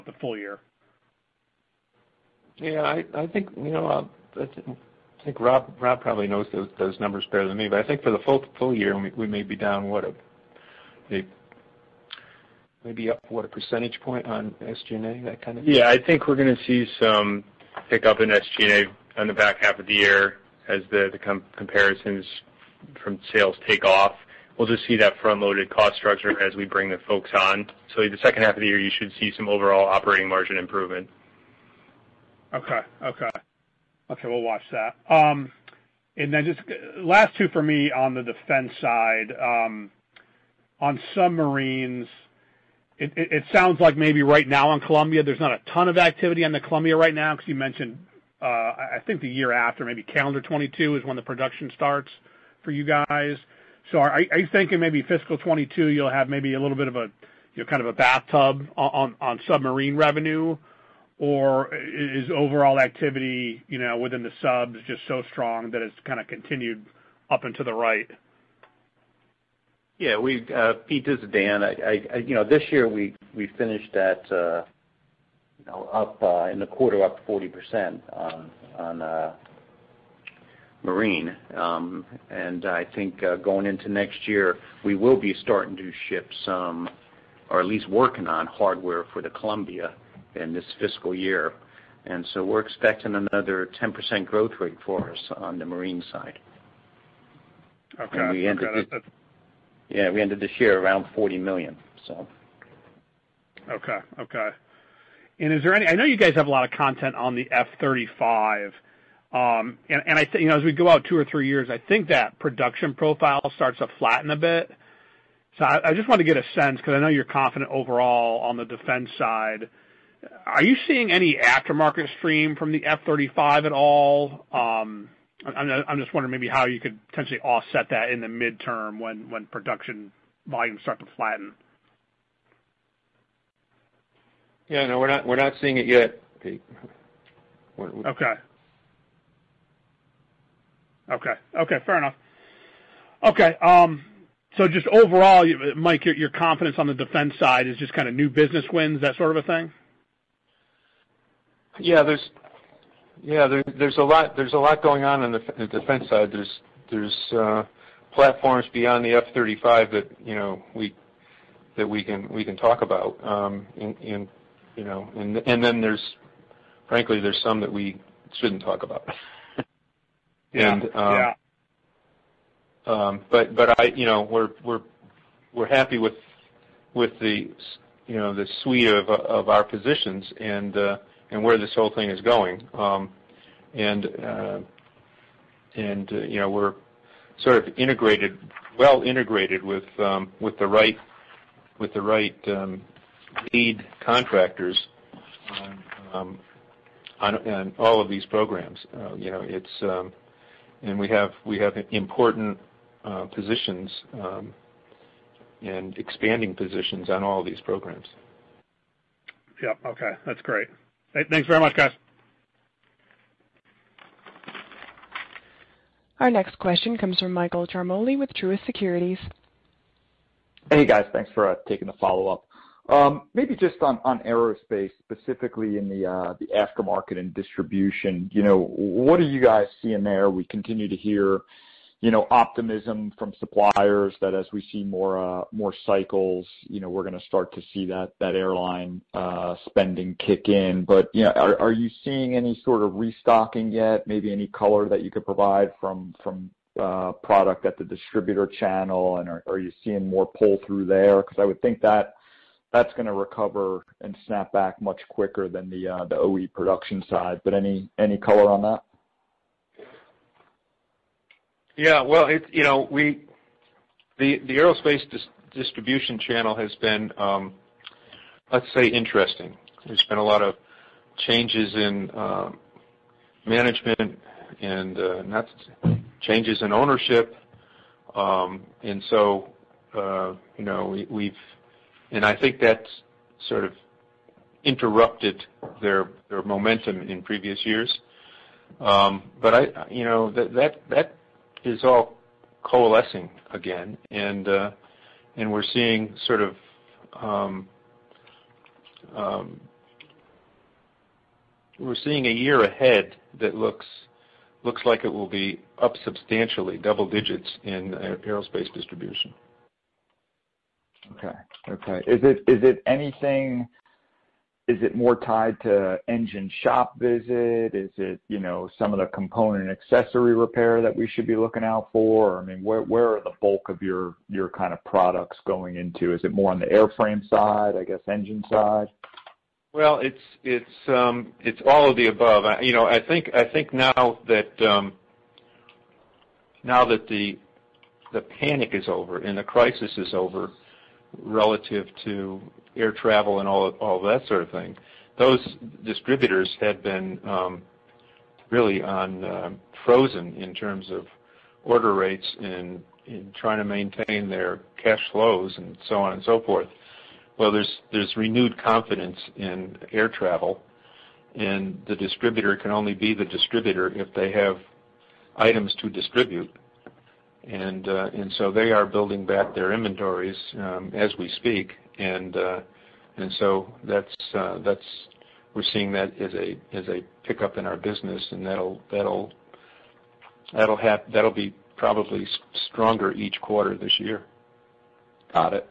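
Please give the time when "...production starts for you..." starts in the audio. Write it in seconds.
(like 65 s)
51 s.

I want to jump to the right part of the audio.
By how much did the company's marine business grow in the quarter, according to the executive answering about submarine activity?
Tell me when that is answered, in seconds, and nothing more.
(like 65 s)
77 s.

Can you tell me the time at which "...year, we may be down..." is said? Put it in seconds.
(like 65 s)
8 s.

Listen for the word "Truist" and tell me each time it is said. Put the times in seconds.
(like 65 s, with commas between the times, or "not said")
218 s.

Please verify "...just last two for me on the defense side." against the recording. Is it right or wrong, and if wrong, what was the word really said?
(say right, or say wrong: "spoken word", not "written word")
right.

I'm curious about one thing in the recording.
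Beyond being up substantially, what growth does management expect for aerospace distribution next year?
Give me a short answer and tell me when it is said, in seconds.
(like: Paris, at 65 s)
Double digits, at 306 s.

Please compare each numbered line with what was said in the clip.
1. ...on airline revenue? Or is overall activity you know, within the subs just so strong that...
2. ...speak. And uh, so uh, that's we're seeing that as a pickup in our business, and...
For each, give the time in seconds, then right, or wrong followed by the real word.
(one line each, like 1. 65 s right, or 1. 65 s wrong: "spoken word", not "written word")
1. 58 s wrong: "submarine", not "airline"
2. 371 s right.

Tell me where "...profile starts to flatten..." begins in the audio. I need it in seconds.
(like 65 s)
112 s.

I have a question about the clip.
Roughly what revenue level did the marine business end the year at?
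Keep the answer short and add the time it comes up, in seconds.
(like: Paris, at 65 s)
$40 million, at 101 s.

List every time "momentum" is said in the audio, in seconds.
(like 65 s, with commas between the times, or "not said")
286 s.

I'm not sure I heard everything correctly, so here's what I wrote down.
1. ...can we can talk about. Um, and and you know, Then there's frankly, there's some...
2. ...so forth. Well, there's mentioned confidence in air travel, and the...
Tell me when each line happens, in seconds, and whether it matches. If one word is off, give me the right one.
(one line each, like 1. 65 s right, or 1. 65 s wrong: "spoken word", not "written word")
1. 162 s right
2. 356 s wrong: "renewed", not "mentioned".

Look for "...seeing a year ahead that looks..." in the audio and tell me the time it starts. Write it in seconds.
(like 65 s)
302 s.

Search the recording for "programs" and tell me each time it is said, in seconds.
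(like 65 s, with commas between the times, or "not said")
198 s, 207 s.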